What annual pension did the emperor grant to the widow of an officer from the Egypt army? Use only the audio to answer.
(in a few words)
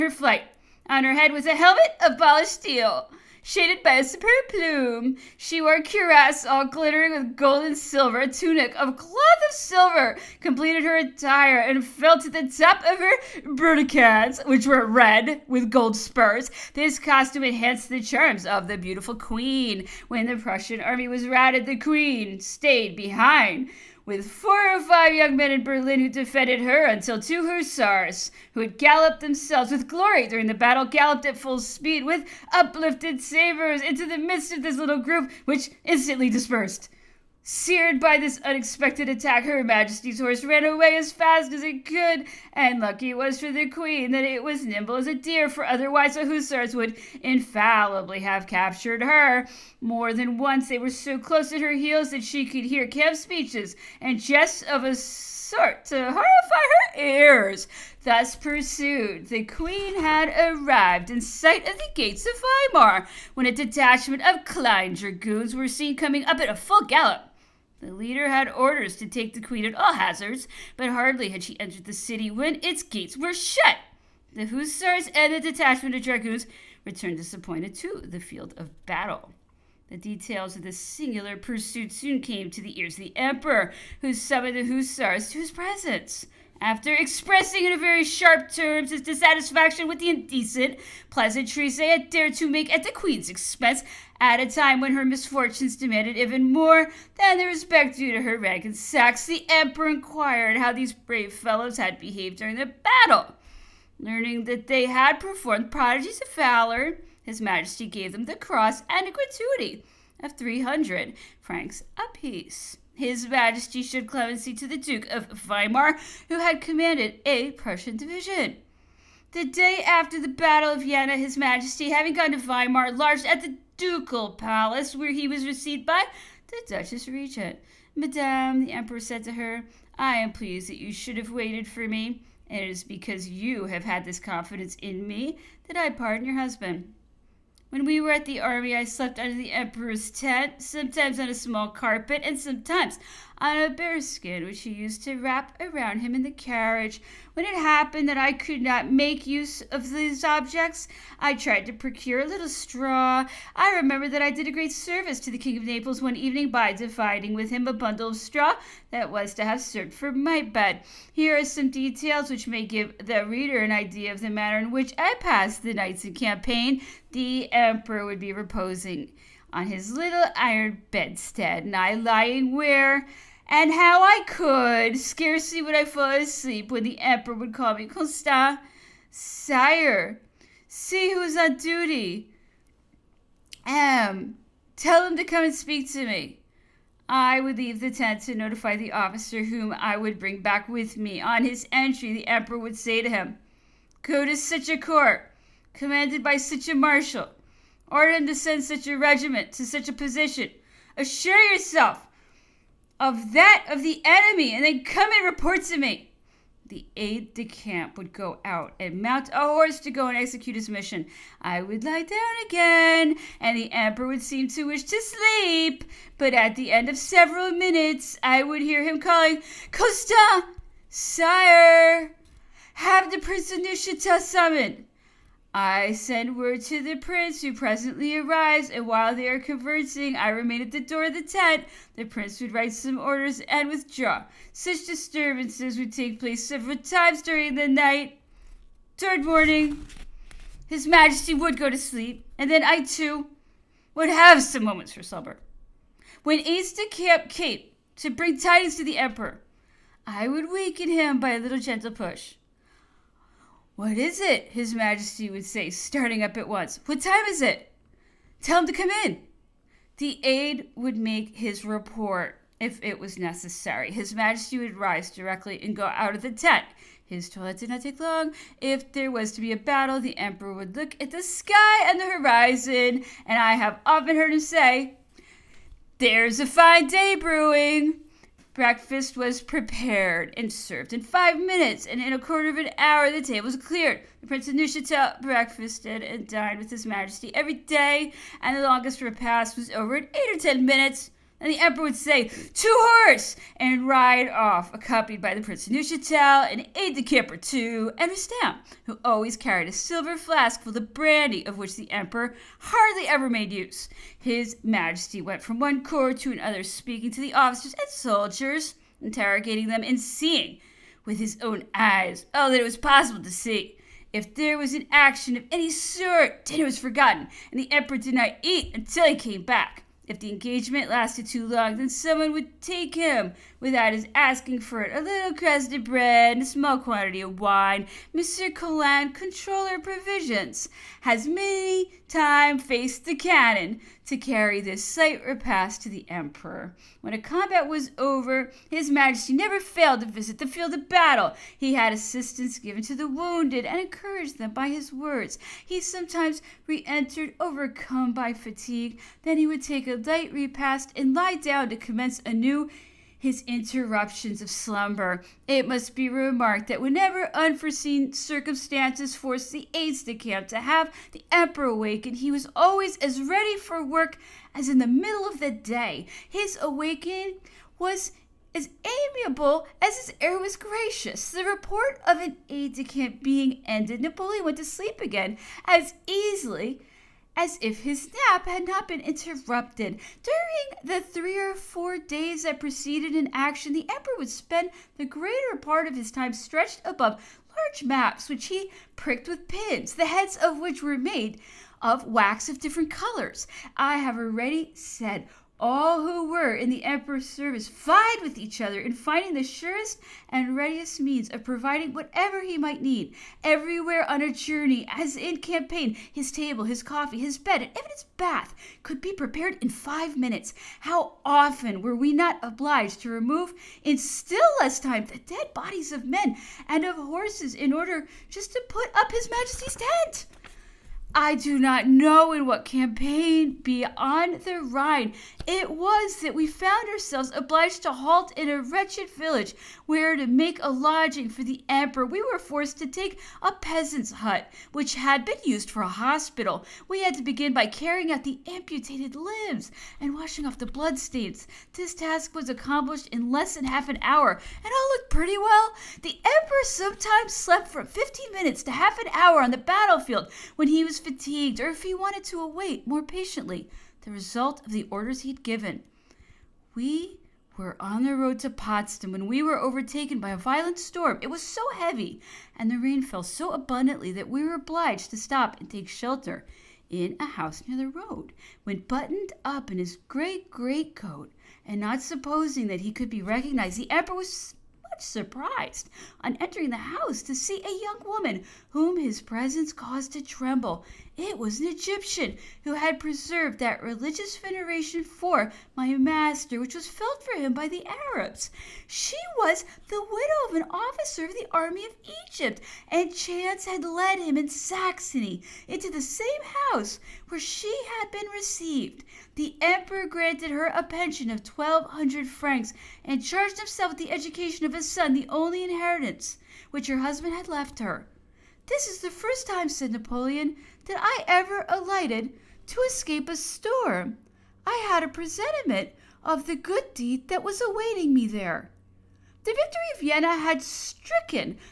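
1200 francs.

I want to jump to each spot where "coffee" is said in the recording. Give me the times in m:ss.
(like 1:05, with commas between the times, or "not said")
6:46.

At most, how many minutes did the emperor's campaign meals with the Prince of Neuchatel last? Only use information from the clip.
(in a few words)
8 or 10 minutes.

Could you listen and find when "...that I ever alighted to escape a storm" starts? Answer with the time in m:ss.
8:30.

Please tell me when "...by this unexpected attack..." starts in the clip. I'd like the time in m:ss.
0:38.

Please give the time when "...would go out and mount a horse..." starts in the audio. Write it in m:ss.
3:27.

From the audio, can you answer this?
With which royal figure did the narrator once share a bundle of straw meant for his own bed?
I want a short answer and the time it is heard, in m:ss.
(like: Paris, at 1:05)
King of Naples, at 2:35.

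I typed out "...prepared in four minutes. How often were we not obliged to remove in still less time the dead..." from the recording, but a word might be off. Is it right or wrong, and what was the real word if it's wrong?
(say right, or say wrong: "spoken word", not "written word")
wrong: "five", not "four".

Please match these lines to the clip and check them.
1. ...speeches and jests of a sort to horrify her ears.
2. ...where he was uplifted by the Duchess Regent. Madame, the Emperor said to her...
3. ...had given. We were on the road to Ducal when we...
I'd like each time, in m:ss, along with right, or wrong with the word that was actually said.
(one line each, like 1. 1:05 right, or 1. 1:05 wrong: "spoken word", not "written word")
1. 0:53 right
2. 2:04 wrong: "received", not "uplifted"
3. 7:35 wrong: "Potsdam", not "Ducal".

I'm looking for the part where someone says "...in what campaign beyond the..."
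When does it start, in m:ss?
7:02.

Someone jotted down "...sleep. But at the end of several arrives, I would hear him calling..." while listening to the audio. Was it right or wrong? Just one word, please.
wrong.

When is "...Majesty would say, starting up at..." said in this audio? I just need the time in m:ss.
4:14.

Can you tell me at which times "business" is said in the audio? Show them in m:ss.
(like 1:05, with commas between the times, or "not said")
not said.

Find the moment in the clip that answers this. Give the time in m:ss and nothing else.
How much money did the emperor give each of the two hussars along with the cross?
1:50.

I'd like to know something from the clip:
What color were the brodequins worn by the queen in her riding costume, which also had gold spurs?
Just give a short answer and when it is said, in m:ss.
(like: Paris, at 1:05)
Red, at 0:14.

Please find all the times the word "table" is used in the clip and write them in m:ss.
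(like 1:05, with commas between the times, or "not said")
4:43, 6:46.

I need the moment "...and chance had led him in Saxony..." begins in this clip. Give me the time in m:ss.
8:12.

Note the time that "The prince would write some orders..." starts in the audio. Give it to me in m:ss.
3:51.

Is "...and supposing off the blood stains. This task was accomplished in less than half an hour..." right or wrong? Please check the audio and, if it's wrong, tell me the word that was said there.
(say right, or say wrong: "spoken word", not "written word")
wrong: "washing", not "supposing".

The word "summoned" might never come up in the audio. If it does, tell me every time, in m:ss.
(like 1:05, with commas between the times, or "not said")
1:24, 3:44.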